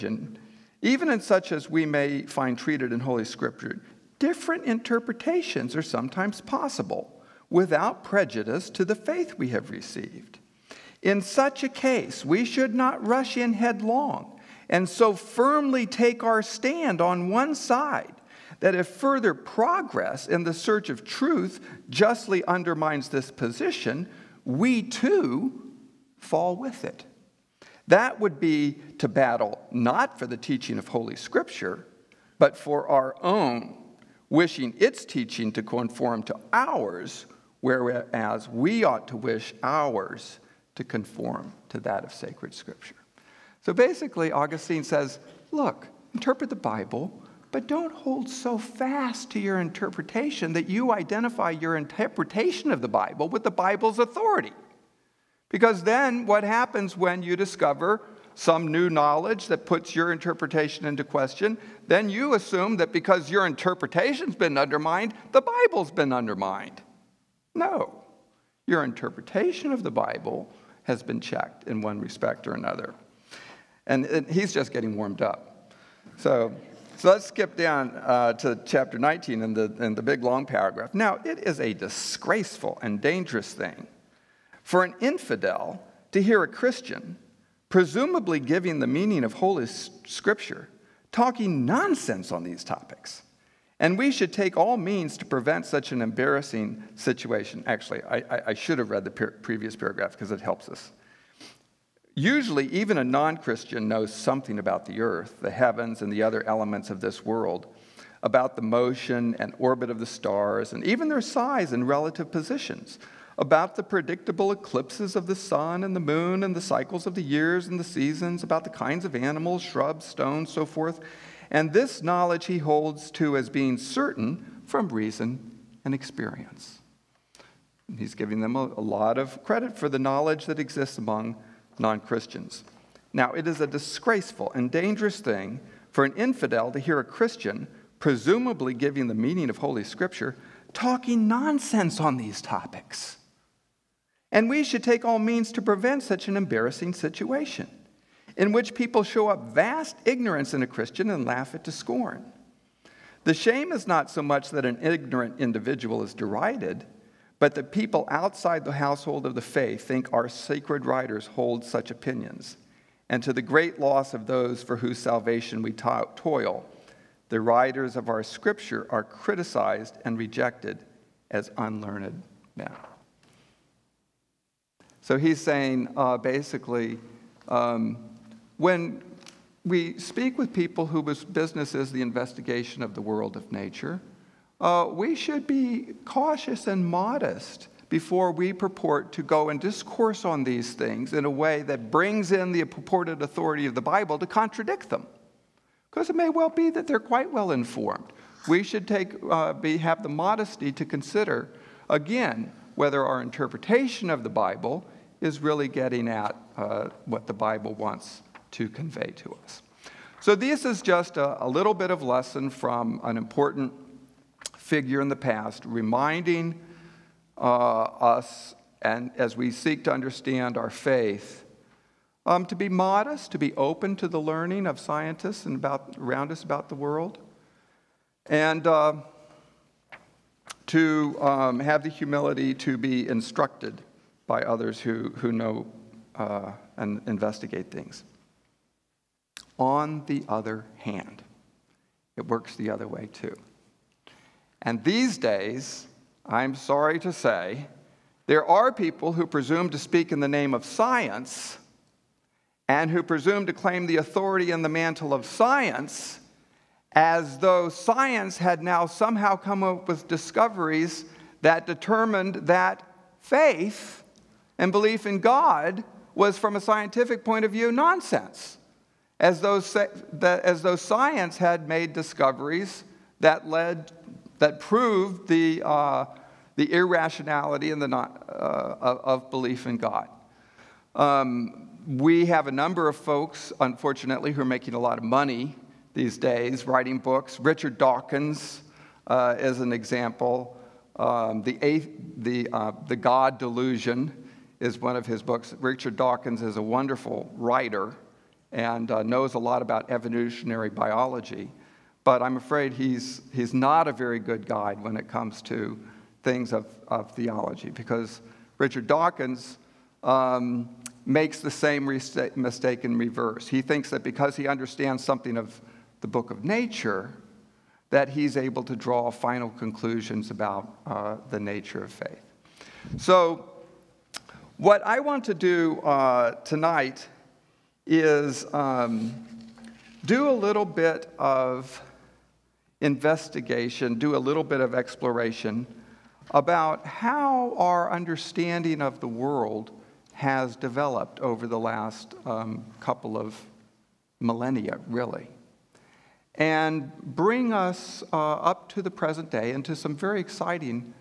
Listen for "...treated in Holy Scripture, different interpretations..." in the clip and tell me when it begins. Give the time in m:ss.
0:02.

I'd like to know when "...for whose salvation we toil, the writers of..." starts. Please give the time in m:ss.
2:44.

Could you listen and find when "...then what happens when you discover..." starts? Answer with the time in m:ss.
0:55.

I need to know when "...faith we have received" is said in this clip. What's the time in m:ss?
0:08.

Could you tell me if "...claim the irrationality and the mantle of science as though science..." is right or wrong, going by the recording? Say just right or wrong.
wrong.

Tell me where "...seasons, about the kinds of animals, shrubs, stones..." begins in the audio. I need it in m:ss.
1:57.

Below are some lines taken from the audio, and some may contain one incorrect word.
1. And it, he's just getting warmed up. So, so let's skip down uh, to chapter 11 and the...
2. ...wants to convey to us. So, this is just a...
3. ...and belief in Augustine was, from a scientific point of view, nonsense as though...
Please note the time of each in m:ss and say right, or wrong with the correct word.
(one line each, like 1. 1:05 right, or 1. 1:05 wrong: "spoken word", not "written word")
1. 1:13 wrong: "19", not "11"
2. 3:27 right
3. 4:24 wrong: "God", not "Augustine".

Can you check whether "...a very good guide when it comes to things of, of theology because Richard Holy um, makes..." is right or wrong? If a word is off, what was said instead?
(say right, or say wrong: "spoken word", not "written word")
wrong: "Dawkins", not "Holy".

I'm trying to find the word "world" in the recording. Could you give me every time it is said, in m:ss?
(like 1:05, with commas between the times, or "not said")
1:47, 3:03, 3:46, 5:39.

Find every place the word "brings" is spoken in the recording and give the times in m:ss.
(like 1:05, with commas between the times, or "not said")
3:11, 5:47.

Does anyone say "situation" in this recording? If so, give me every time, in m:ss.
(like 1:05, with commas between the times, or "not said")
1:36, 2:26.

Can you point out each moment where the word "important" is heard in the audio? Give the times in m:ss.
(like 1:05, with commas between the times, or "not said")
3:33.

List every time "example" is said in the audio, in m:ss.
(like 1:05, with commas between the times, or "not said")
4:49.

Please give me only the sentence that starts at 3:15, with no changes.
Because it may well be that they're quite well informed.